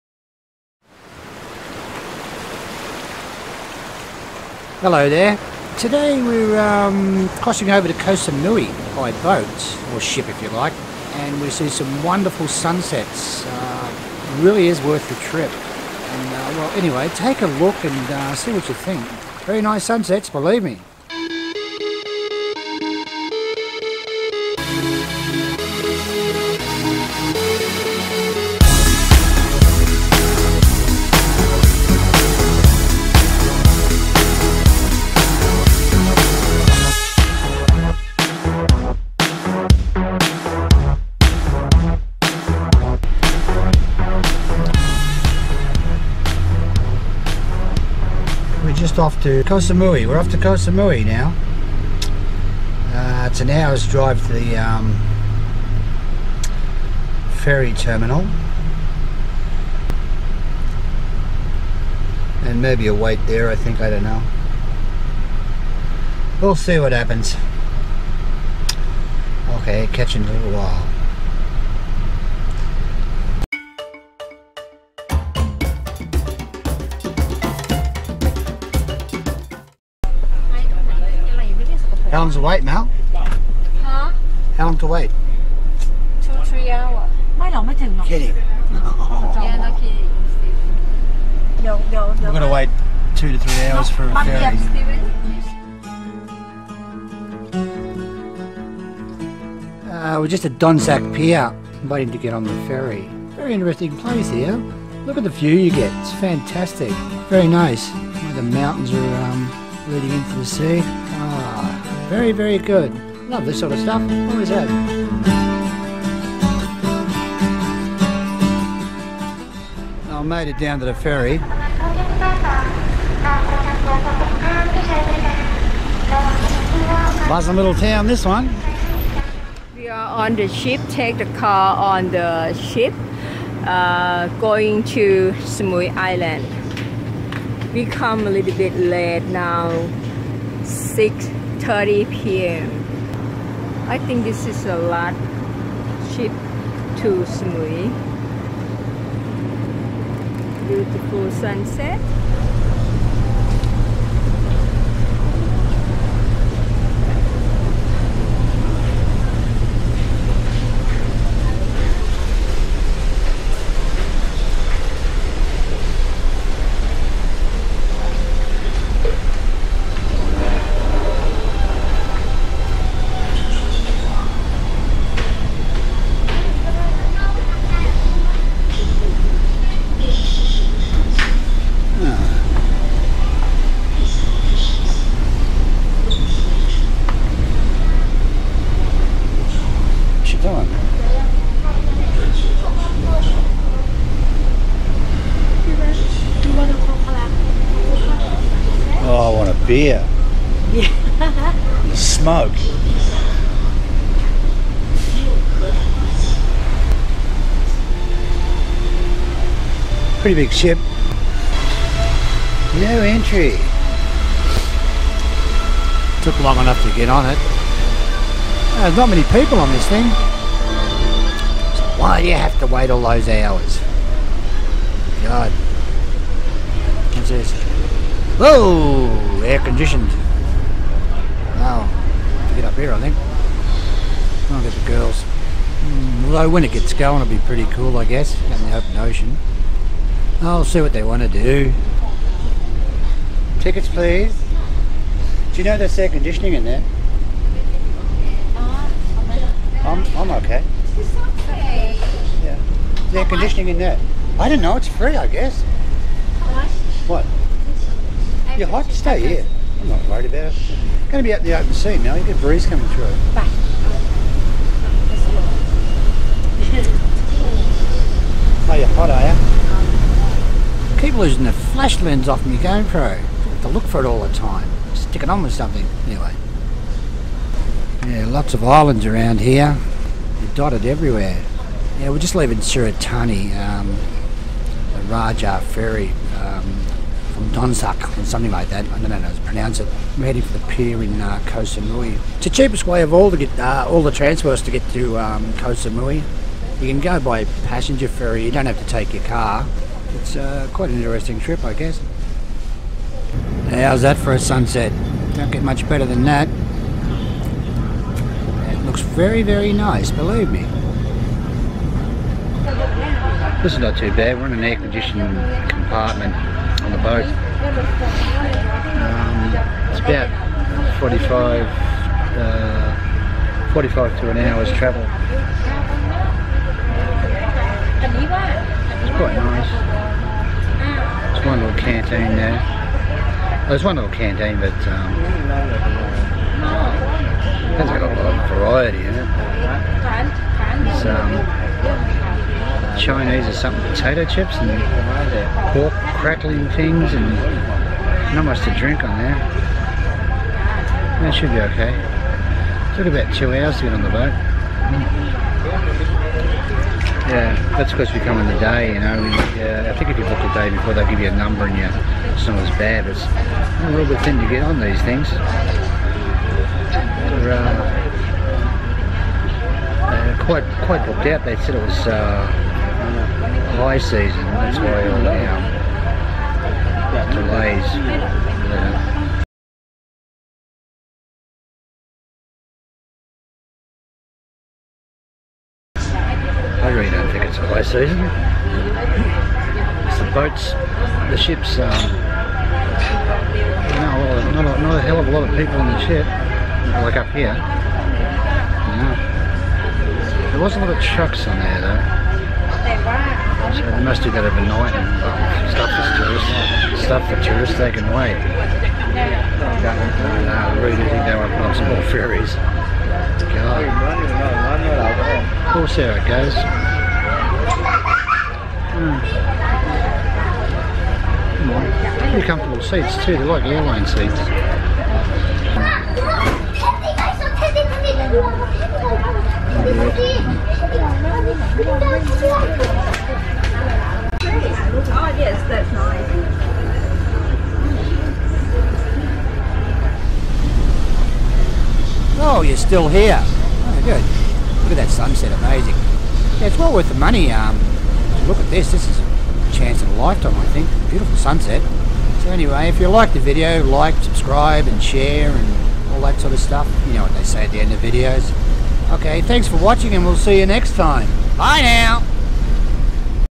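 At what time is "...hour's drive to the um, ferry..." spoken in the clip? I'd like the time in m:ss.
0:53.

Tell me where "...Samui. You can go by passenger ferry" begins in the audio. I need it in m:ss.
4:55.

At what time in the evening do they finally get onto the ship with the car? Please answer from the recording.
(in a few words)
6:30 p.m.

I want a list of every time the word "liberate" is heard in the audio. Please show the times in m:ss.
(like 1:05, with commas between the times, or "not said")
not said.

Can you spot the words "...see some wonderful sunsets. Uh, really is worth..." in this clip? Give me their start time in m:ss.
0:11.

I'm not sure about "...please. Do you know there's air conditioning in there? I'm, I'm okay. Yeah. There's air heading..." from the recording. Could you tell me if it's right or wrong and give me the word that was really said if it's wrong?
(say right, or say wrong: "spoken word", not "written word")
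wrong: "conditioning", not "heading".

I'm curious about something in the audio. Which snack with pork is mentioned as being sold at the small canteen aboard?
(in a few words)
Pork crackling.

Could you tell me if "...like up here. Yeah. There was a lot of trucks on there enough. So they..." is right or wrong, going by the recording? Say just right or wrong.
wrong.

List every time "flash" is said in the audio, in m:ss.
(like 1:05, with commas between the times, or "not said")
4:31.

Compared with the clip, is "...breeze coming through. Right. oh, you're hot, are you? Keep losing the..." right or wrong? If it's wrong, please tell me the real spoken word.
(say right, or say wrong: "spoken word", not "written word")
right.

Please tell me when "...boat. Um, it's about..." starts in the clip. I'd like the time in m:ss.
5:17.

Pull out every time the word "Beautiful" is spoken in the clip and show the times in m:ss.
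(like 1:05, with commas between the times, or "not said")
2:30, 7:31.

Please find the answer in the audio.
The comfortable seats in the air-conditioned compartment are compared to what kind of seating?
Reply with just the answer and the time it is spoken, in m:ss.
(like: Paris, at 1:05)
Airline seats, at 7:03.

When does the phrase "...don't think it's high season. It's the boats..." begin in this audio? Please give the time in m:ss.
6:27.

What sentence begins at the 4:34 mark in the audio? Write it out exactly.
Stick it on with something, anyway.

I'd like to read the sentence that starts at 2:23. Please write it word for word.
I think this is a lot cheap to Samui.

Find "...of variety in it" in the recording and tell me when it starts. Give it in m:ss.
5:38.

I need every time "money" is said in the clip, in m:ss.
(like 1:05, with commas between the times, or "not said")
7:27.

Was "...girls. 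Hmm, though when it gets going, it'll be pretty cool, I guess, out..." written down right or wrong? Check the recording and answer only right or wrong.
wrong.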